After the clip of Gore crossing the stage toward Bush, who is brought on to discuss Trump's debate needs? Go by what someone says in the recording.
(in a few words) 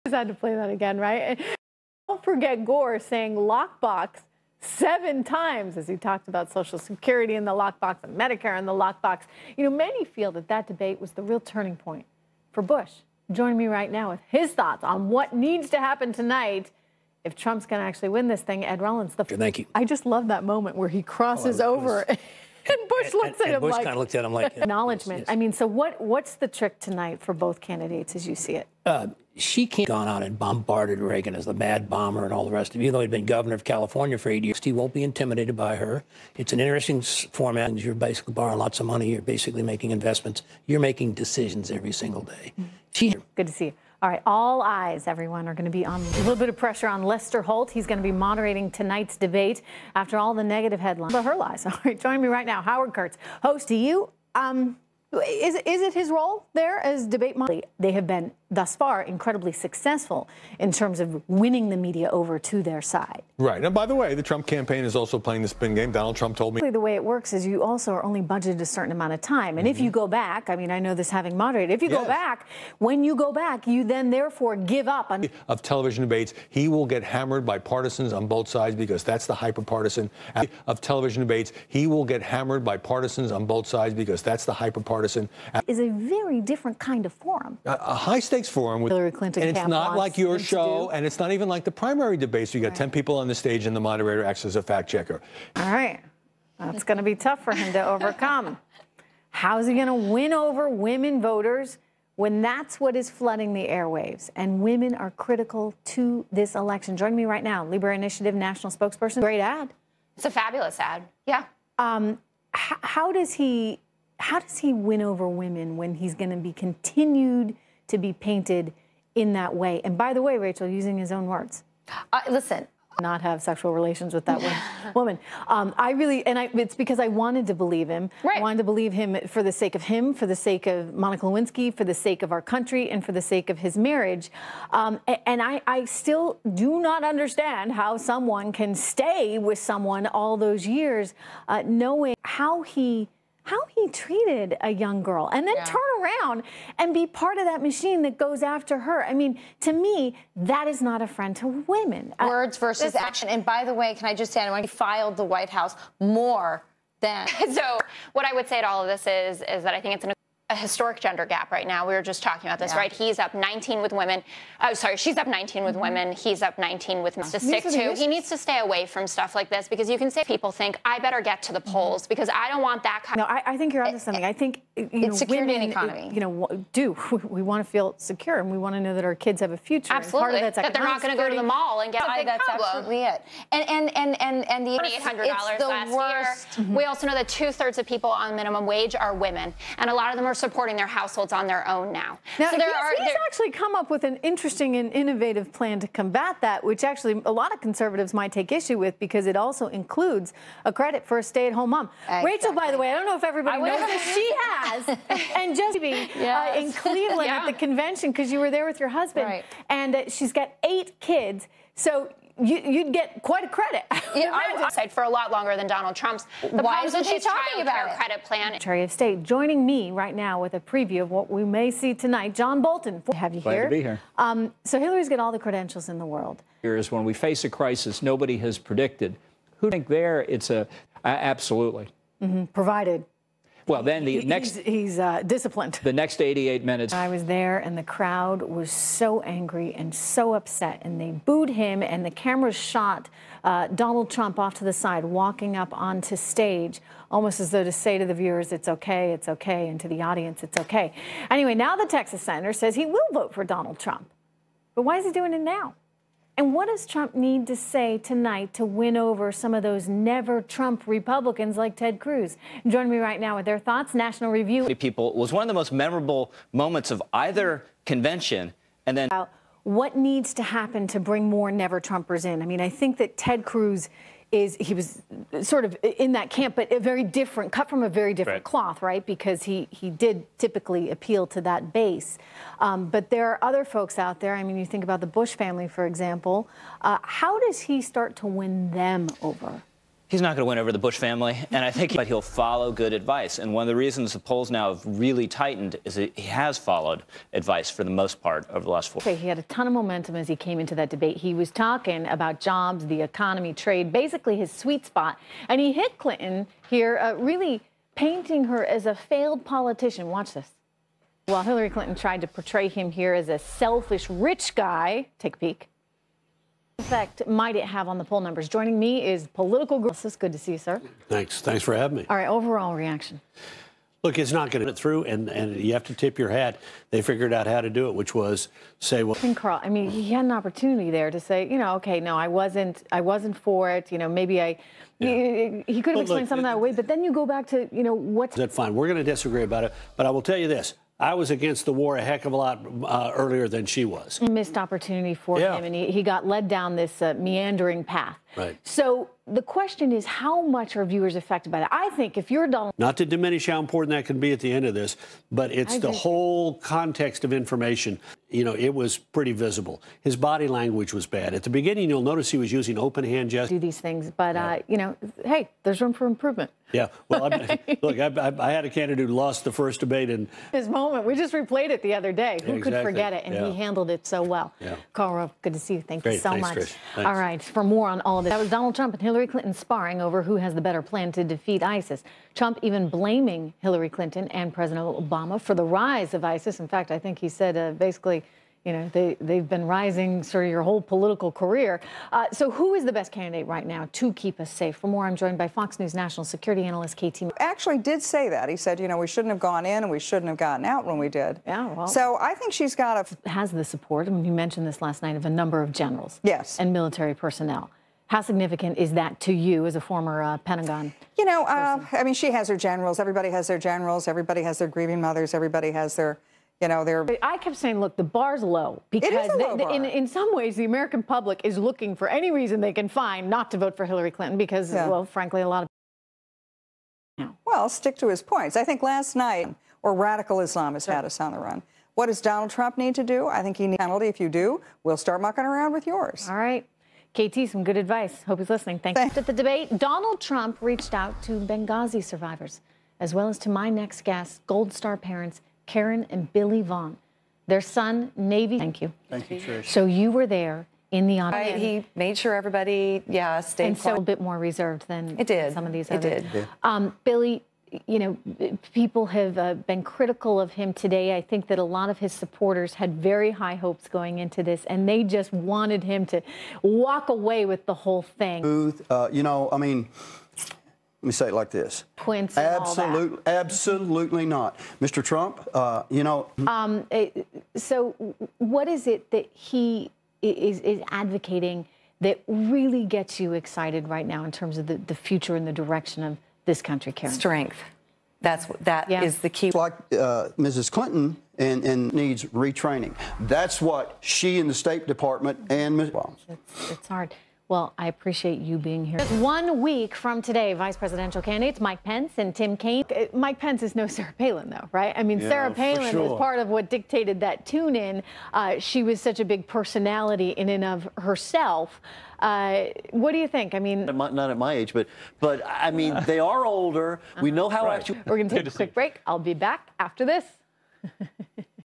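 Ed Rollins.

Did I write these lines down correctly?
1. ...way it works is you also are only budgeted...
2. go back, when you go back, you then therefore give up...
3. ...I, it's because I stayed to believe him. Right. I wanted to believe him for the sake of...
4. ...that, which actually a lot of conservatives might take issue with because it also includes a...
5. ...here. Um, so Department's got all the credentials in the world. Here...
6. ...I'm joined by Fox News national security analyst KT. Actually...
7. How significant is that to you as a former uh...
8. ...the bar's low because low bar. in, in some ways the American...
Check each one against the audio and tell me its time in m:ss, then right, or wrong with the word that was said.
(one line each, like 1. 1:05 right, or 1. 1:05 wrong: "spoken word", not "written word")
1. 1:06 right
2. 1:12 right
3. 2:06 wrong: "wanted", not "stayed"
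4. 3:16 right
5. 3:43 wrong: "Hillary", not "Department"
6. 6:35 right
7. 6:48 right
8. 6:57 right.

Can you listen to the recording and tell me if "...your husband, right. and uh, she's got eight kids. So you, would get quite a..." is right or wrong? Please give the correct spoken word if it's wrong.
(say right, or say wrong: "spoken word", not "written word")
right.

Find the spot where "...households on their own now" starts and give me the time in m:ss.
3:10.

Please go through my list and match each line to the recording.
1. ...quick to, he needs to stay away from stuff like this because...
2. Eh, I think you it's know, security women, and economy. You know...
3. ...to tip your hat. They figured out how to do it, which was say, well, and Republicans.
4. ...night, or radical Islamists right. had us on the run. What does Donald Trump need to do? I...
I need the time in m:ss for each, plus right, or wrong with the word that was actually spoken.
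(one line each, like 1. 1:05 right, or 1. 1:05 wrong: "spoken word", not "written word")
1. 2:47 wrong: "stick", not "quick"
2. 2:54 right
3. 5:25 wrong: "Karl", not "Republicans"
4. 7:09 right.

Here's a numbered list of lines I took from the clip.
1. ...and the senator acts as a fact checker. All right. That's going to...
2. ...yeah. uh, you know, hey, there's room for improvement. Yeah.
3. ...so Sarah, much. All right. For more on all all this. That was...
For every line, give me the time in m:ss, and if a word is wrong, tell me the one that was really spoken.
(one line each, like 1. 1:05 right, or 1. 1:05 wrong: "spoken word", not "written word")
1. 1:33 wrong: "moderator", not "senator"
2. 6:04 right
3. 6:16 wrong: "Thanks", not "Sarah".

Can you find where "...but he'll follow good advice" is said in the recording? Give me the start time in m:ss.
4:51.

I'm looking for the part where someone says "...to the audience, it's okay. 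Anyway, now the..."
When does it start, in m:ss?
4:09.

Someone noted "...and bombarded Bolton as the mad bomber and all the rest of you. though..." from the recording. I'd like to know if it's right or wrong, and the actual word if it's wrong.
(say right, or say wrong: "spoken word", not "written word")
wrong: "Reagan", not "Bolton".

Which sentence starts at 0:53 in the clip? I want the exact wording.
Do you um, is is it his role there as debate moderator?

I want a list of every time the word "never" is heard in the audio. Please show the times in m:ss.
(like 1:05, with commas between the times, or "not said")
4:19, 4:31.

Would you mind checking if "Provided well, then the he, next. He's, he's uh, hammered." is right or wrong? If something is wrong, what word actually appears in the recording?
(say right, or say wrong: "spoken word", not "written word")
wrong: "disciplined", not "hammered".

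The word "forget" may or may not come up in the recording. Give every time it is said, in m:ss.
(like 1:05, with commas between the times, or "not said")
0:02, 6:12.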